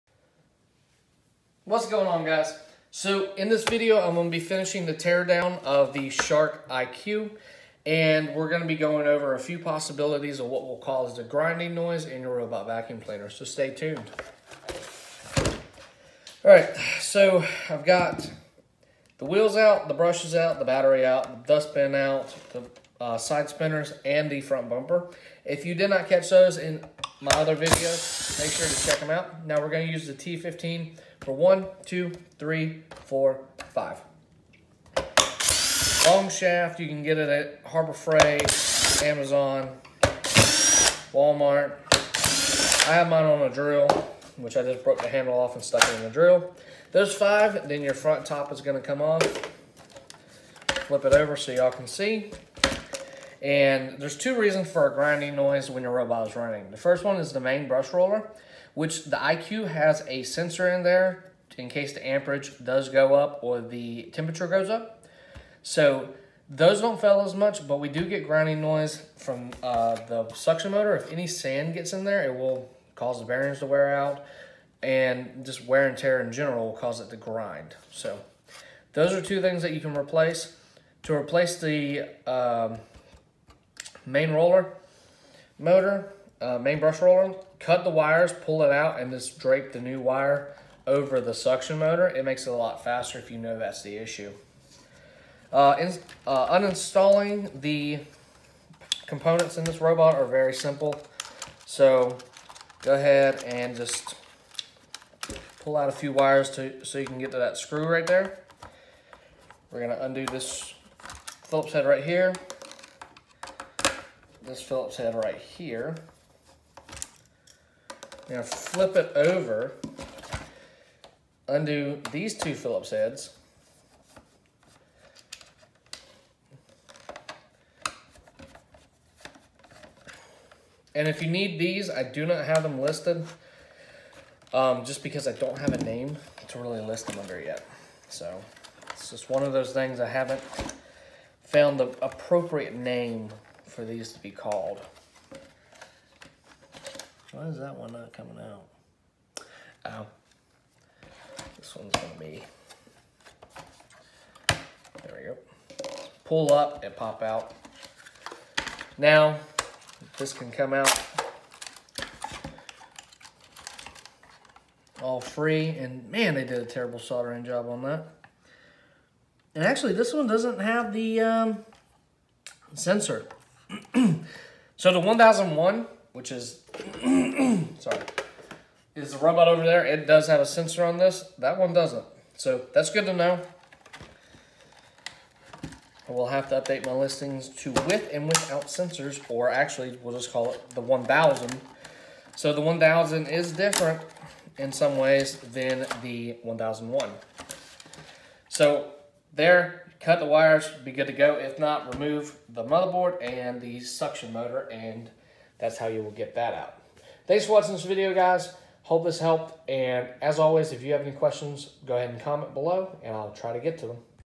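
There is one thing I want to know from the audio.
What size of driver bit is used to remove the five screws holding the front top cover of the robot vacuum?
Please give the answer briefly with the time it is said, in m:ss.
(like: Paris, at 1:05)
T15, at 0:30.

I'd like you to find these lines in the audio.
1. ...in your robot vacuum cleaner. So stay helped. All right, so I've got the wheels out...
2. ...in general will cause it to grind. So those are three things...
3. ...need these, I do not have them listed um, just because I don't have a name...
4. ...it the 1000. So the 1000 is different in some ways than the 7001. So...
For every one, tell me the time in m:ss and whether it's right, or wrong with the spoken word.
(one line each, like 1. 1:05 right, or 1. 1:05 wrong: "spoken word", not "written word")
1. 0:12 wrong: "tuned", not "helped"
2. 1:16 wrong: "two", not "three"
3. 2:11 right
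4. 3:10 wrong: "1001", not "7001".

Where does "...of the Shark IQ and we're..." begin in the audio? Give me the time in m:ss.
0:05.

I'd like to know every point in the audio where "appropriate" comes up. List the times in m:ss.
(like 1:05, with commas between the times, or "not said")
2:22.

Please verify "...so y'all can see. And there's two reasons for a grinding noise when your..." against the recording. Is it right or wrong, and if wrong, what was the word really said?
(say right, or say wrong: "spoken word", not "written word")
right.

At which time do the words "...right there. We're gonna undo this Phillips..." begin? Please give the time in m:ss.
1:47.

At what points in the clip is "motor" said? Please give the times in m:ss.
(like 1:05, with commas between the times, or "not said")
1:10, 1:25, 1:31, 3:24.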